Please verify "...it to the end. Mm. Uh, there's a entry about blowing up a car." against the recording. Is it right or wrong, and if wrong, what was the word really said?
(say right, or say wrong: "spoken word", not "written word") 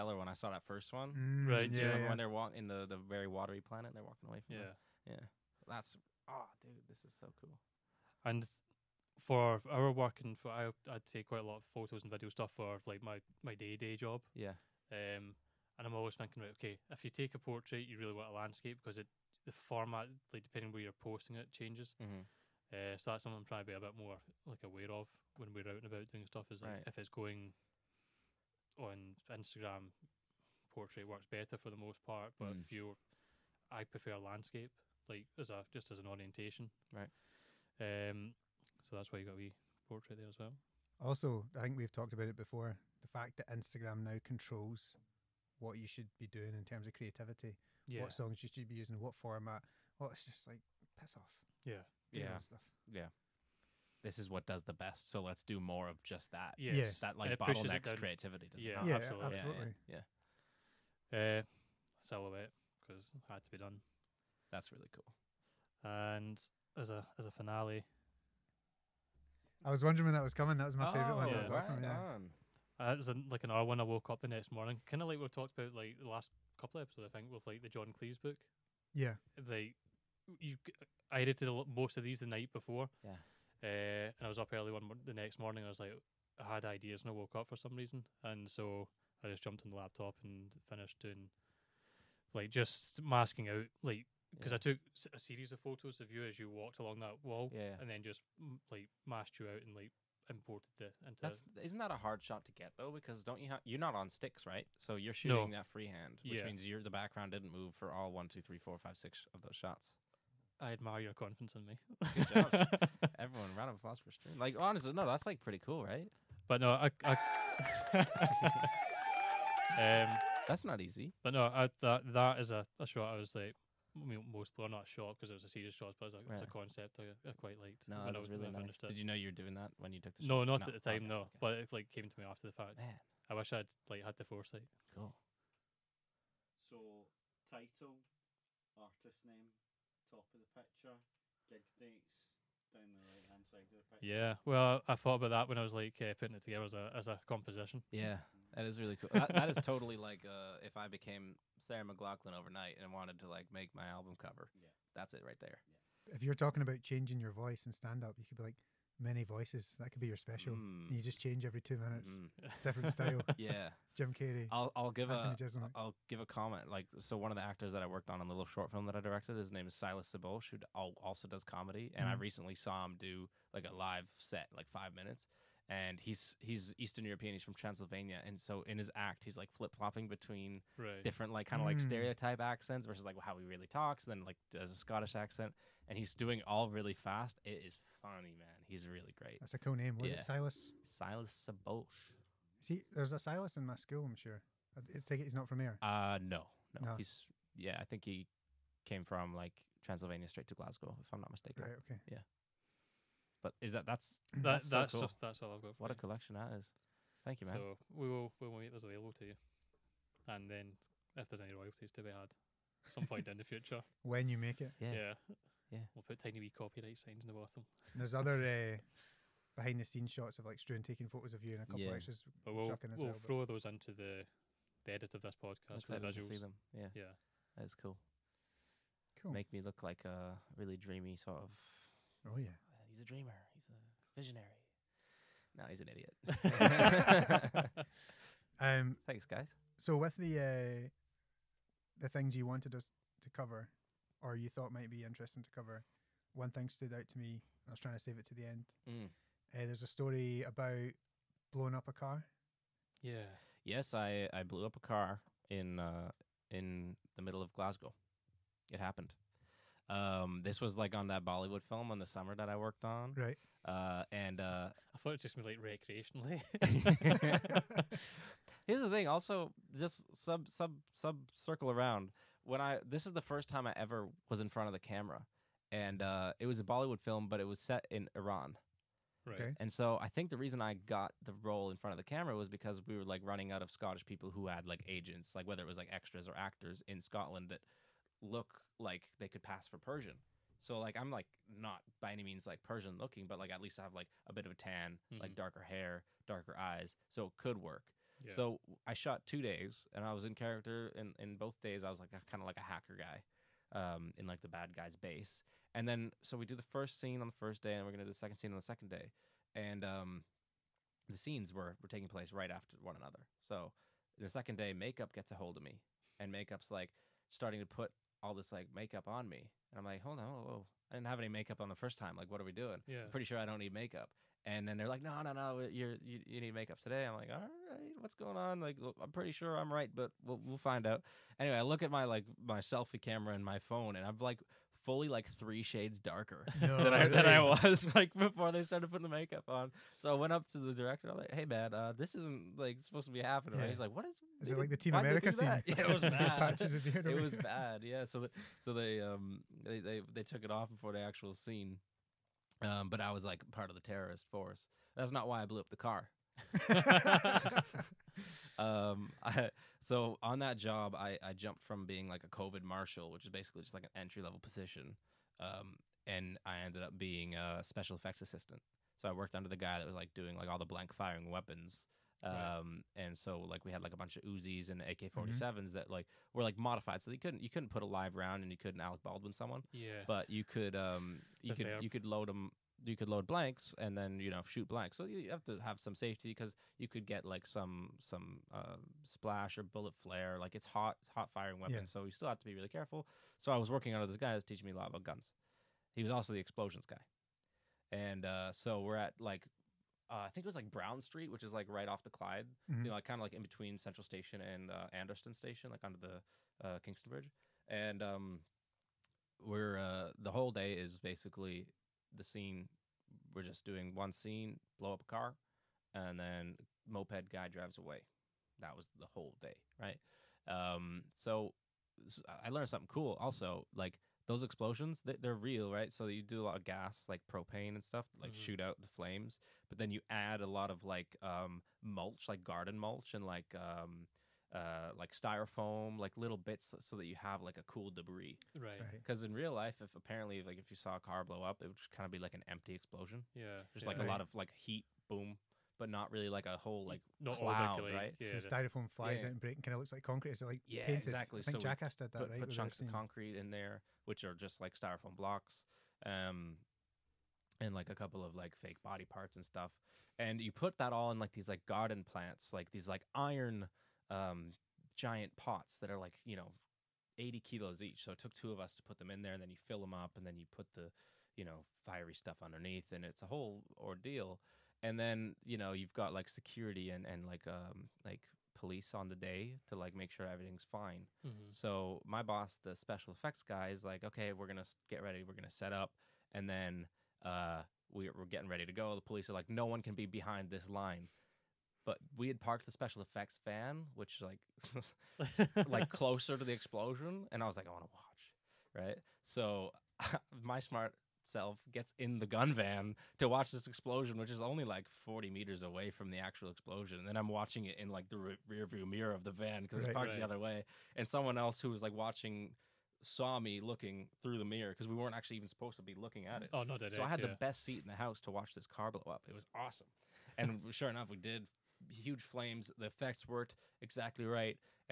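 wrong: "story", not "entry".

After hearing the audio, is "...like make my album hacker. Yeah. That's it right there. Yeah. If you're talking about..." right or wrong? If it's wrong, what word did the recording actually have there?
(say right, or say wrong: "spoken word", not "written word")
wrong: "cover", not "hacker".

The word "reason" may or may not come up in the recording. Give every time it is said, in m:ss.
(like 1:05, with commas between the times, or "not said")
1:27, 4:40.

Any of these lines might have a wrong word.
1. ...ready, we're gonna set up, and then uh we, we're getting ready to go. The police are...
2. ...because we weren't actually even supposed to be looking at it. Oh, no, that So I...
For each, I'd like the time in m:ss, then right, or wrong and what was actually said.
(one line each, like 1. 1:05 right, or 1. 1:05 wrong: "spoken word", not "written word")
1. 8:05 right
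2. 8:34 right.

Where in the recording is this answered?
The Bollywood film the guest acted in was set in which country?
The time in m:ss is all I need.
4:38.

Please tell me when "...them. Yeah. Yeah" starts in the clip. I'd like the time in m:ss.
3:46.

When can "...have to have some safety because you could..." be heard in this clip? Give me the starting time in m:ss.
6:25.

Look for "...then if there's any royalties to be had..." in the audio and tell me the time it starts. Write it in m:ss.
3:30.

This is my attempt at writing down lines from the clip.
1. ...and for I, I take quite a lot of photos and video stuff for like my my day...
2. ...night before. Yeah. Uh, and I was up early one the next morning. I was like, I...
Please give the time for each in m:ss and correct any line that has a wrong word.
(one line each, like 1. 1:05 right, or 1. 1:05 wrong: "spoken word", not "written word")
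1. 0:10 right
2. 1:22 right.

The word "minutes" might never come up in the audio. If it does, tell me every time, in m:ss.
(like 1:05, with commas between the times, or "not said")
2:41, 2:54.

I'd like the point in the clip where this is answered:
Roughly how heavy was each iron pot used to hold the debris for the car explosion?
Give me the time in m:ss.
7:47.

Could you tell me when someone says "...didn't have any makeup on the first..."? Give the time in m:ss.
5:20.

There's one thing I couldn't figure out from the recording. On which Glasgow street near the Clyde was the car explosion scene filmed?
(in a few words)
Brown Street.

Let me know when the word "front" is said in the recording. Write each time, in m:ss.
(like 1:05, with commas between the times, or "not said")
4:34, 4:41.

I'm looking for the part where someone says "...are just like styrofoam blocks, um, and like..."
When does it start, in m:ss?
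7:34.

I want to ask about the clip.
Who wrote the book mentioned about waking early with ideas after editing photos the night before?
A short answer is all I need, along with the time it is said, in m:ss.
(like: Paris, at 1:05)
John Cleese, at 1:17.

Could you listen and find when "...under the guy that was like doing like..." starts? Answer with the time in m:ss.
6:09.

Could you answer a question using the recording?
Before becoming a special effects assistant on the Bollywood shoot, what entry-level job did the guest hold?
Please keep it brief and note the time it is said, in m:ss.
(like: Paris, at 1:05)
COVID marshal, at 6:02.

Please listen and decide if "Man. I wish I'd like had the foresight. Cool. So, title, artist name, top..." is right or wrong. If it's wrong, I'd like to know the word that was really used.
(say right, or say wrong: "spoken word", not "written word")
right.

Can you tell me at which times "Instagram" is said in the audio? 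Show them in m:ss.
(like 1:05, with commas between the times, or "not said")
0:29, 0:43.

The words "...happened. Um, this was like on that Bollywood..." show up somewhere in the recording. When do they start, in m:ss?
4:18.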